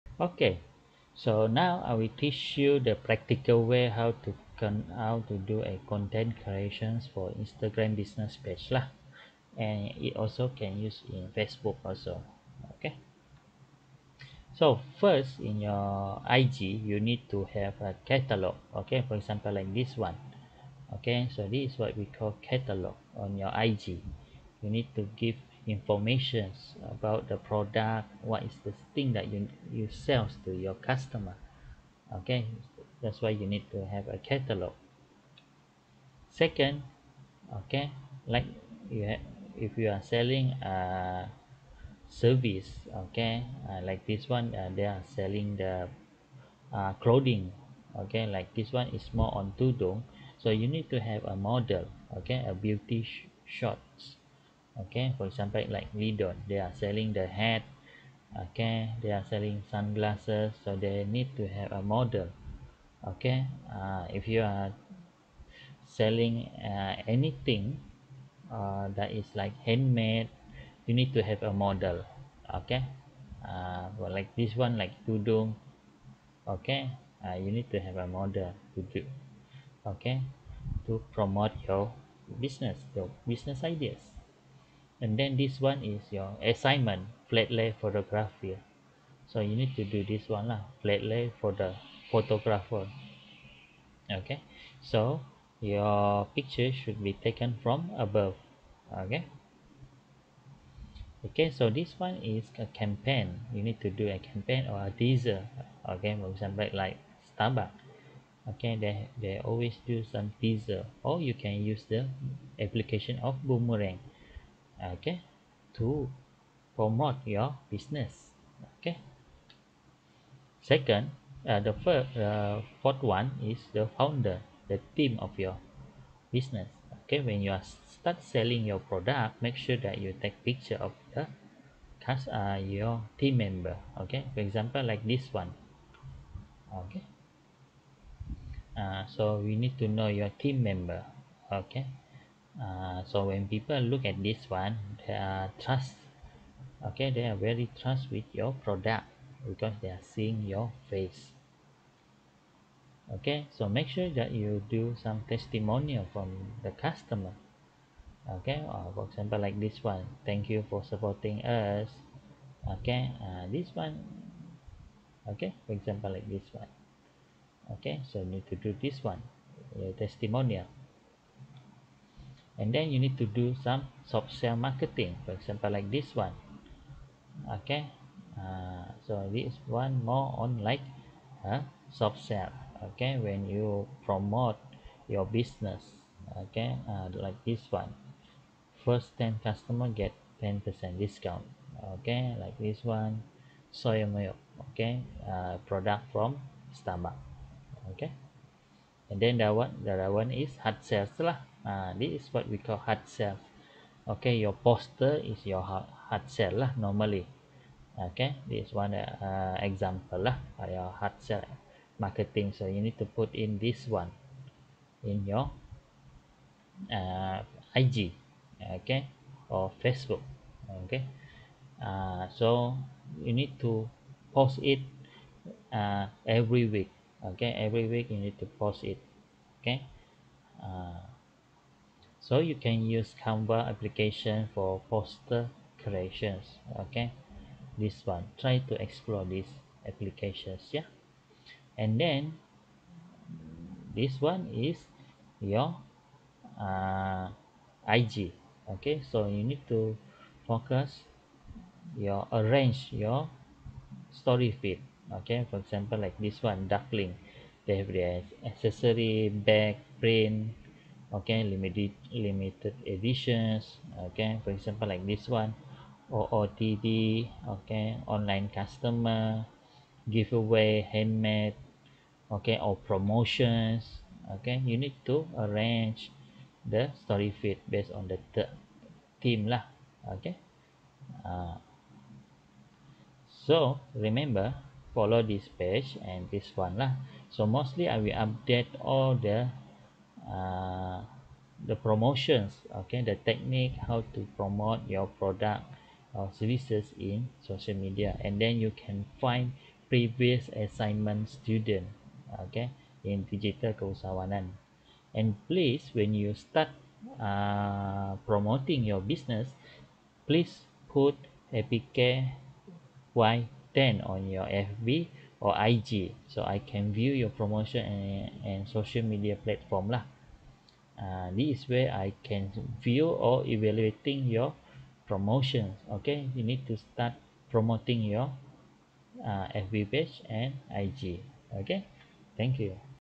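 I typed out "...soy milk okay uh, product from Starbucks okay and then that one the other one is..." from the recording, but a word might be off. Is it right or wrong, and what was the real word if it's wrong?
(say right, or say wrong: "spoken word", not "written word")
right.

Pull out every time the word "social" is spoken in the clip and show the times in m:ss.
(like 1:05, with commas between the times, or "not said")
4:57, 5:18.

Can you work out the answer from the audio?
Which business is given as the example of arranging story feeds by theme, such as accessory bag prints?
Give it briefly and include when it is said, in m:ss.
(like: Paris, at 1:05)
Duckling, at 4:16.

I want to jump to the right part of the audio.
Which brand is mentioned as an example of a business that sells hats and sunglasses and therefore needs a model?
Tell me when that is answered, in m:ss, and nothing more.
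0:55.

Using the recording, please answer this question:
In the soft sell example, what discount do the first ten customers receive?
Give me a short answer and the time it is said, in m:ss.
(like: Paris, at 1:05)
10%, at 3:10.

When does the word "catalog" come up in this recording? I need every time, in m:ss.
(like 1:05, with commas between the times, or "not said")
0:18, 0:22, 0:34.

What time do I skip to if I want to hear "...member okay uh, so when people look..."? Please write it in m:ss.
2:20.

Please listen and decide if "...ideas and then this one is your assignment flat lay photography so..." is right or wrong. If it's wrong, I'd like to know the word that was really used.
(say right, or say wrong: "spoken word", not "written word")
right.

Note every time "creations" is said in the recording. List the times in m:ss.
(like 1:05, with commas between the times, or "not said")
0:06, 3:55.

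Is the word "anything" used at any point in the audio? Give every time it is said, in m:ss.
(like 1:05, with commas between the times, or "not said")
1:07.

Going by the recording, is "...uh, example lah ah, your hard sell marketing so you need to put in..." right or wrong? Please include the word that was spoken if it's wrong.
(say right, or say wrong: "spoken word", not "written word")
right.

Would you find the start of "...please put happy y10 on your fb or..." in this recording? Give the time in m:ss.
5:10.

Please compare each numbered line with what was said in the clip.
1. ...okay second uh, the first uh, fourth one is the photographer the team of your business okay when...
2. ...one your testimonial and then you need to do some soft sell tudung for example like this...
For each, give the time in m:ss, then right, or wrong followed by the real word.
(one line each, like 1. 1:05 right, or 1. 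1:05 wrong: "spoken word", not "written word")
1. 1:58 wrong: "founder", not "photographer"
2. 2:49 wrong: "marketing", not "tudung".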